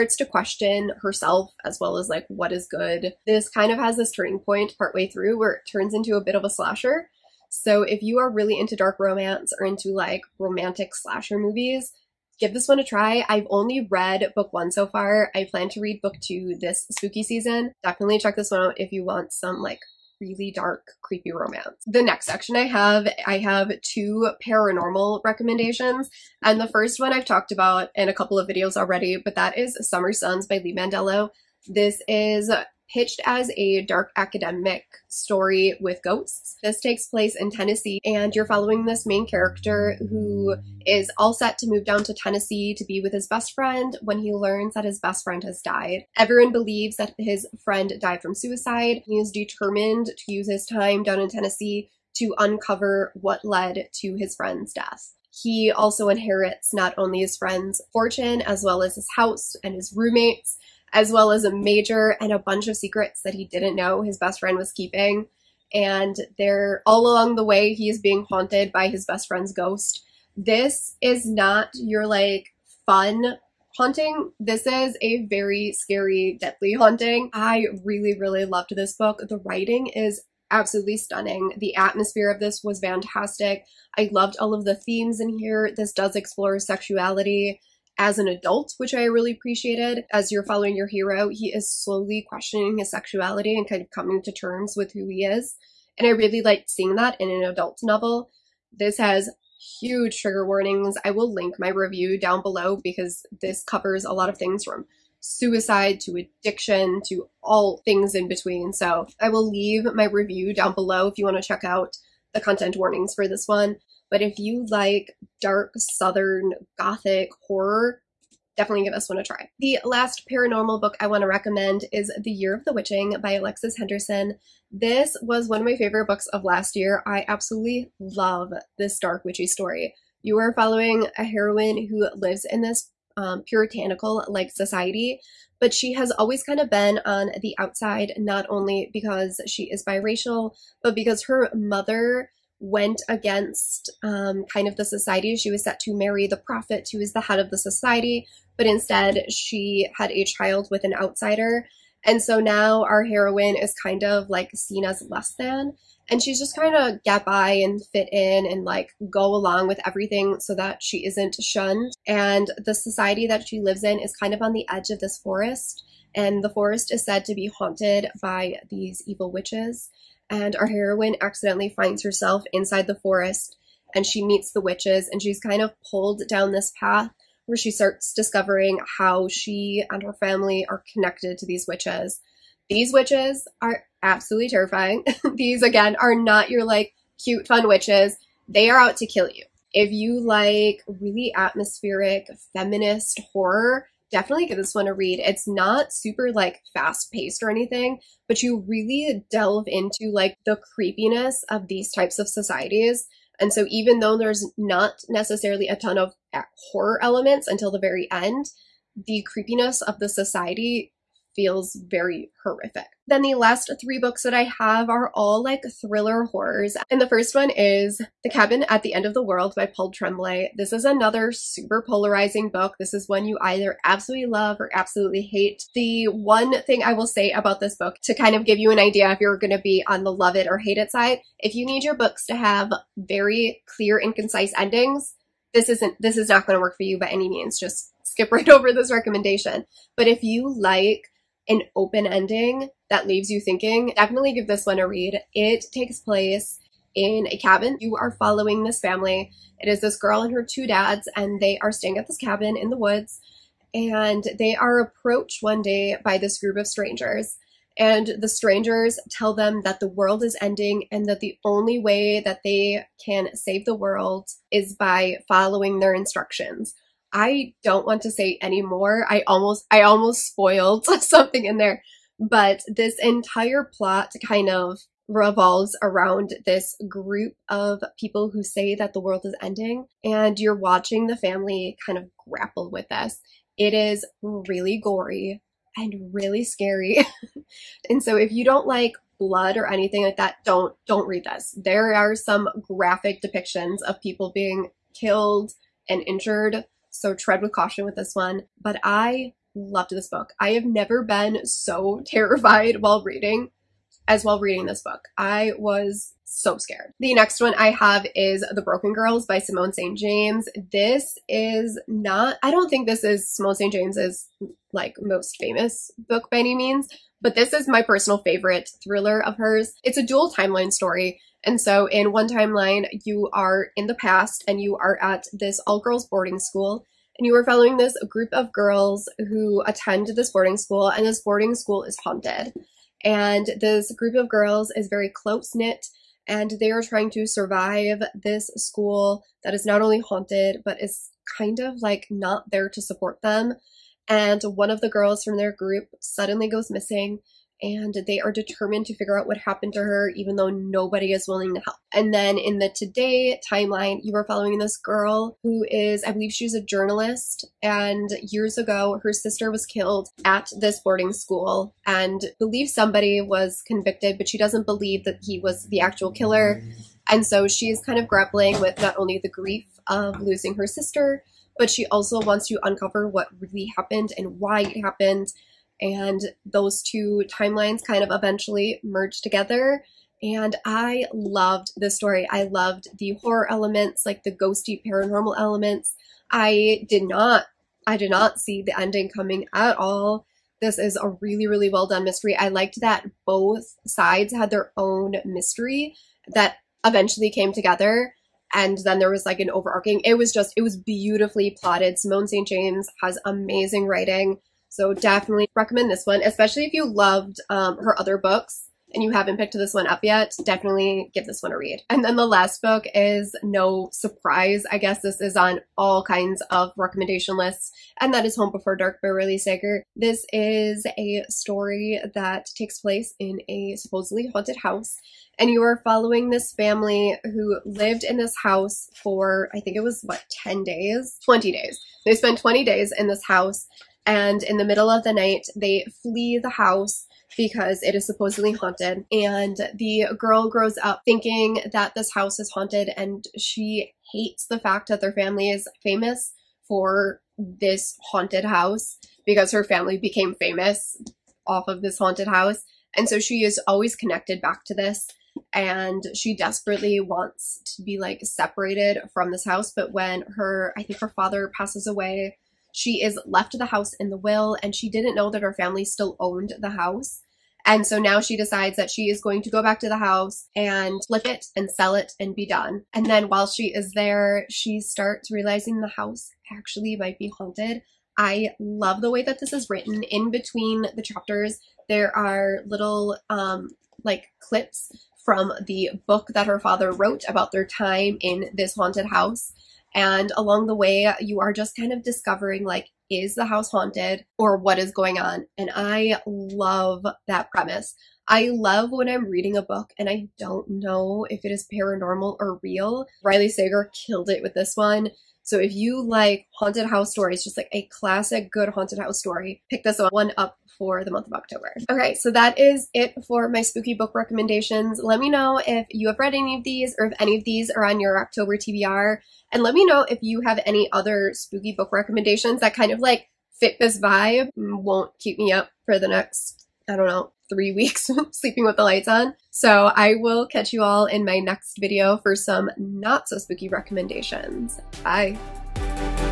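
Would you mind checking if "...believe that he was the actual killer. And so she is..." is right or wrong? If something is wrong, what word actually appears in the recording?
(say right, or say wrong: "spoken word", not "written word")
right.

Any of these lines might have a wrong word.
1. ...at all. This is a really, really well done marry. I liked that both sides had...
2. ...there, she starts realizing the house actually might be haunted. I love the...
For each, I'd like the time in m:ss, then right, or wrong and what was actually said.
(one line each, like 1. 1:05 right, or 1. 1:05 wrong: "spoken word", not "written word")
1. 6:29 wrong: "mystery", not "marry"
2. 7:53 right.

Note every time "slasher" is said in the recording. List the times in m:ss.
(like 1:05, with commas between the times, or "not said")
0:06, 0:10.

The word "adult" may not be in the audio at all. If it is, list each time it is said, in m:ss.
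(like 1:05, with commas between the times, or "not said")
1:28, 1:37.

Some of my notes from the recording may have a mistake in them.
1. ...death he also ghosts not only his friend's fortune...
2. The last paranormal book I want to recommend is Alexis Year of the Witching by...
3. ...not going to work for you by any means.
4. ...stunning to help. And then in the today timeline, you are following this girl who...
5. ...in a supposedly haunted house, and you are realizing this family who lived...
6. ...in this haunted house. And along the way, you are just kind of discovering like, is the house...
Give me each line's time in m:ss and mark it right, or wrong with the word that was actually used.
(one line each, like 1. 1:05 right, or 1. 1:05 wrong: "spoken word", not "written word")
1. 0:54 wrong: "inherits", not "ghosts"
2. 1:59 wrong: "The", not "Alexis"
3. 3:56 right
4. 5:51 wrong: "willing", not "stunning"
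5. 7:03 wrong: "following", not "realizing"
6. 8:08 right.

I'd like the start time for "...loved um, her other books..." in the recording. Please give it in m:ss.
6:46.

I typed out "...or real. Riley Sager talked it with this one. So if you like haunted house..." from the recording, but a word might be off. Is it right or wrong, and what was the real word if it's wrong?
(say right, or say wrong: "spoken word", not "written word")
wrong: "killed", not "talked".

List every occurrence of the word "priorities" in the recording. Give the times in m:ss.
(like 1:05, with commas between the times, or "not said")
not said.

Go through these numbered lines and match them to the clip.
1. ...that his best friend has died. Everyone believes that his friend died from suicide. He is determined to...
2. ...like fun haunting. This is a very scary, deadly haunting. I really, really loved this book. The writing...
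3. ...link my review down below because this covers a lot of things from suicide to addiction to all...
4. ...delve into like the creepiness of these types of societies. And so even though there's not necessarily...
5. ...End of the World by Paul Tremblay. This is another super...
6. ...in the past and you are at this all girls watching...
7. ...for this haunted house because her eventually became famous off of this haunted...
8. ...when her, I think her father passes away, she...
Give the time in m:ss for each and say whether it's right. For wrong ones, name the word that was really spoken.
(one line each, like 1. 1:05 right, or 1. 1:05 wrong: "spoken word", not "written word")
1. 0:44 right
2. 1:12 right
3. 1:41 right
4. 3:19 right
5. 3:38 right
6. 5:23 wrong: "boarding", not "watching"
7. 7:26 wrong: "family", not "eventually"
8. 7:39 right.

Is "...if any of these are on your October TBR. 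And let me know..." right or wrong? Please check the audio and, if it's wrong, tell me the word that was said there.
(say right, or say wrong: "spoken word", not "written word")
right.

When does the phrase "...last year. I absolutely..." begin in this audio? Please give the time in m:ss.
2:06.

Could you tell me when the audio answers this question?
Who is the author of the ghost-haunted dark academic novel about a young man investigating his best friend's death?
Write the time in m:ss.
0:30.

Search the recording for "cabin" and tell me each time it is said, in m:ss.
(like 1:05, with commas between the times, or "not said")
3:38, 4:07, 4:12.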